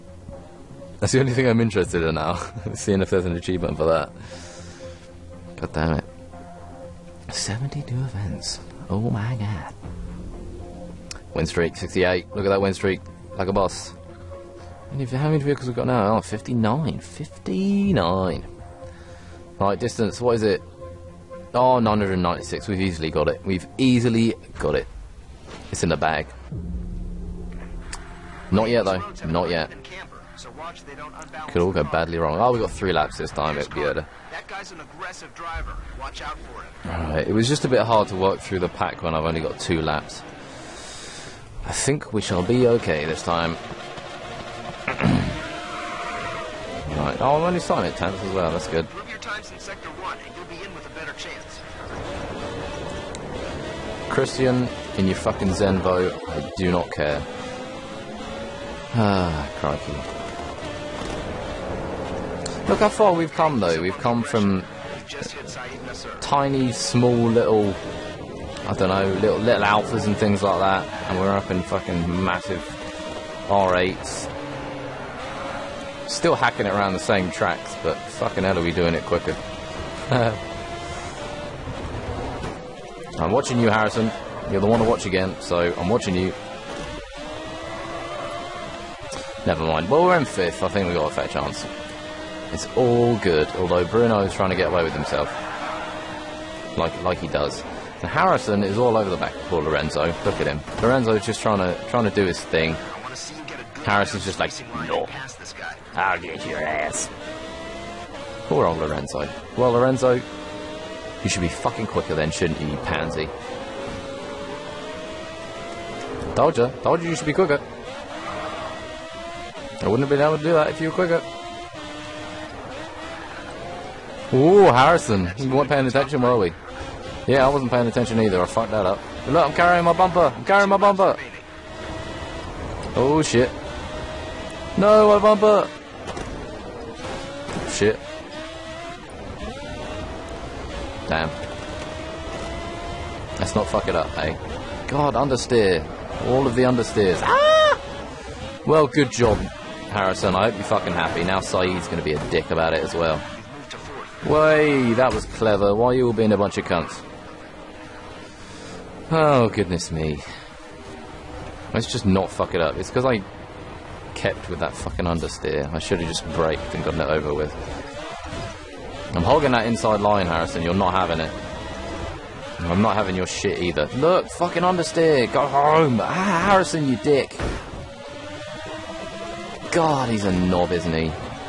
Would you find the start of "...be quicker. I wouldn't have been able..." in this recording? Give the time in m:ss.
1:57.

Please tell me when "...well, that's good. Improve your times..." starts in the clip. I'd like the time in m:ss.
0:48.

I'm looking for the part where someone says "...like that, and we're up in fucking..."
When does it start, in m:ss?
1:10.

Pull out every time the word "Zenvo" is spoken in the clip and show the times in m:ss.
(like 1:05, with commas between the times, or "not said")
0:55.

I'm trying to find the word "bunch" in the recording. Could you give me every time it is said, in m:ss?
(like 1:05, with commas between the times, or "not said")
2:36.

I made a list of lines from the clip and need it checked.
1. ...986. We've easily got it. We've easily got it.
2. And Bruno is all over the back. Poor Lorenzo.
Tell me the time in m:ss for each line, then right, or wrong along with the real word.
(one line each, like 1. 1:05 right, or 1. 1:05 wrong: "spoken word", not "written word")
1. 0:21 wrong: "996", not "986"
2. 1:38 wrong: "Harrison", not "Bruno".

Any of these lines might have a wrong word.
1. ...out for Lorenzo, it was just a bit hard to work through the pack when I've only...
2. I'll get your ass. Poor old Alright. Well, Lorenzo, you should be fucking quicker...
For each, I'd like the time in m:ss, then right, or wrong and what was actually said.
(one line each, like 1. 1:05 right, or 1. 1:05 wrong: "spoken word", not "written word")
1. 0:36 wrong: "Alright", not "Lorenzo"
2. 1:45 wrong: "Lorenzo", not "Alright".